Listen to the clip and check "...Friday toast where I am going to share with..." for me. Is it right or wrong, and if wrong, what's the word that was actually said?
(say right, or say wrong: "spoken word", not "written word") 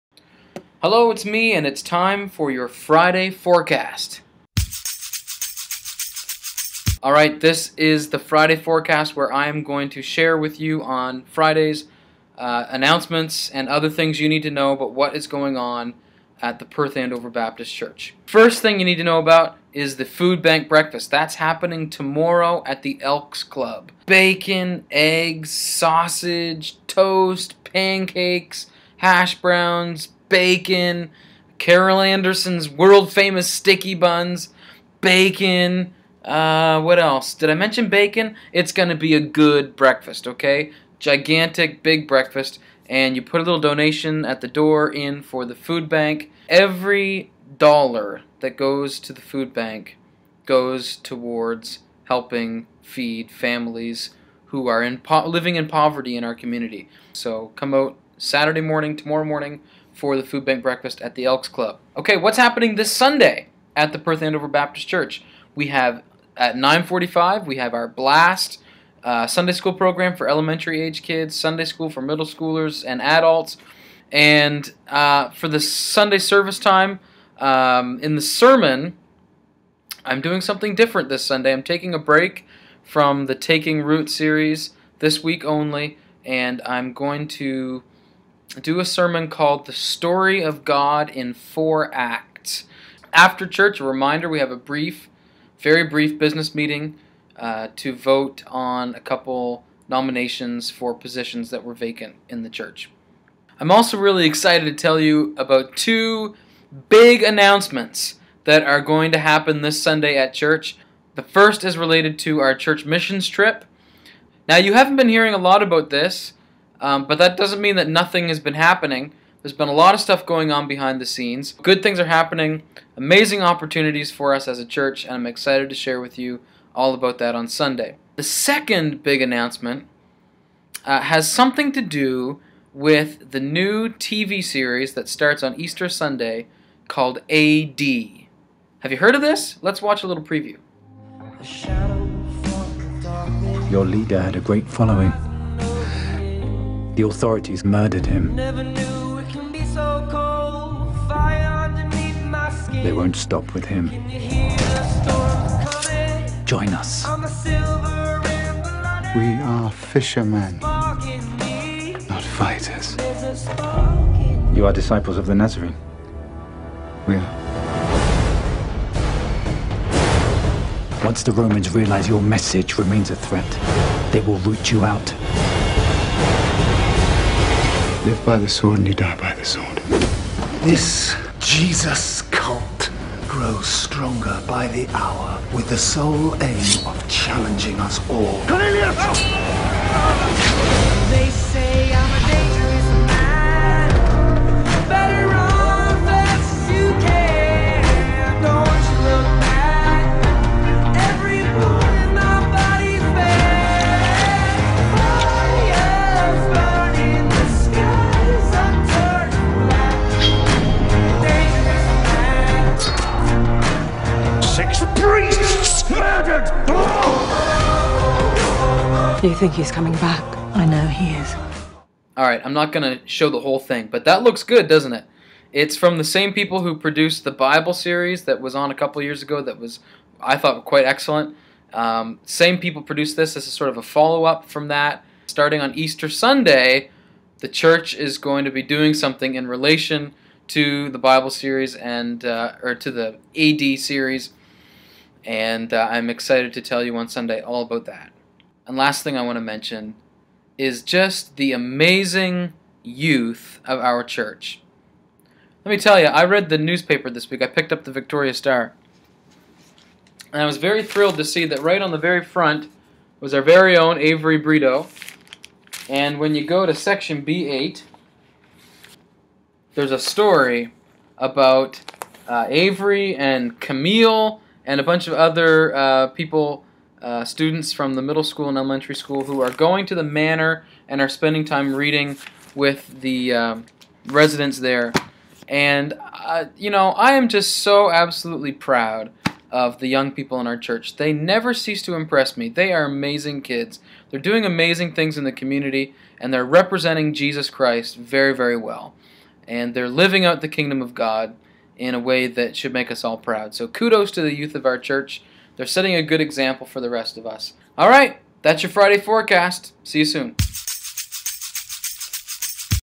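wrong: "forecast", not "toast".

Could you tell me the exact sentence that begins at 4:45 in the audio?
And, uh, you know, I am just so absolutely proud of the young people in our church.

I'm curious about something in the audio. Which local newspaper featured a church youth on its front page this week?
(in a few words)
Victoria Star.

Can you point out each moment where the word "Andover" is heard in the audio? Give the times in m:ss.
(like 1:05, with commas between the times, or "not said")
0:16, 1:04.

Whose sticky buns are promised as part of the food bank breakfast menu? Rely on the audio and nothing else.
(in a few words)
Carol Anderson.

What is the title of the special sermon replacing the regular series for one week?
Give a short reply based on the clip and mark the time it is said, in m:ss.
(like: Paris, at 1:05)
The Story of God in Four Acts, at 1:29.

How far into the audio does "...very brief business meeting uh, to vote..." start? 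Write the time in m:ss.
1:35.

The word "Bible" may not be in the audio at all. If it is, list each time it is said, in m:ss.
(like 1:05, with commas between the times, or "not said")
3:47, 4:00.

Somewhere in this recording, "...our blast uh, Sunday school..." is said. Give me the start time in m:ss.
1:07.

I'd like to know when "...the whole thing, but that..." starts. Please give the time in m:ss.
3:43.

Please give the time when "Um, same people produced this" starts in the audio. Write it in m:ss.
3:51.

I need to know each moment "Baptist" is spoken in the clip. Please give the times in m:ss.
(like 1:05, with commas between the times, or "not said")
0:17, 1:04.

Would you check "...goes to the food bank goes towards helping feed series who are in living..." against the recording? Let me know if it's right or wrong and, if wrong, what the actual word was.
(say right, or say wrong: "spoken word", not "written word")
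wrong: "families", not "series".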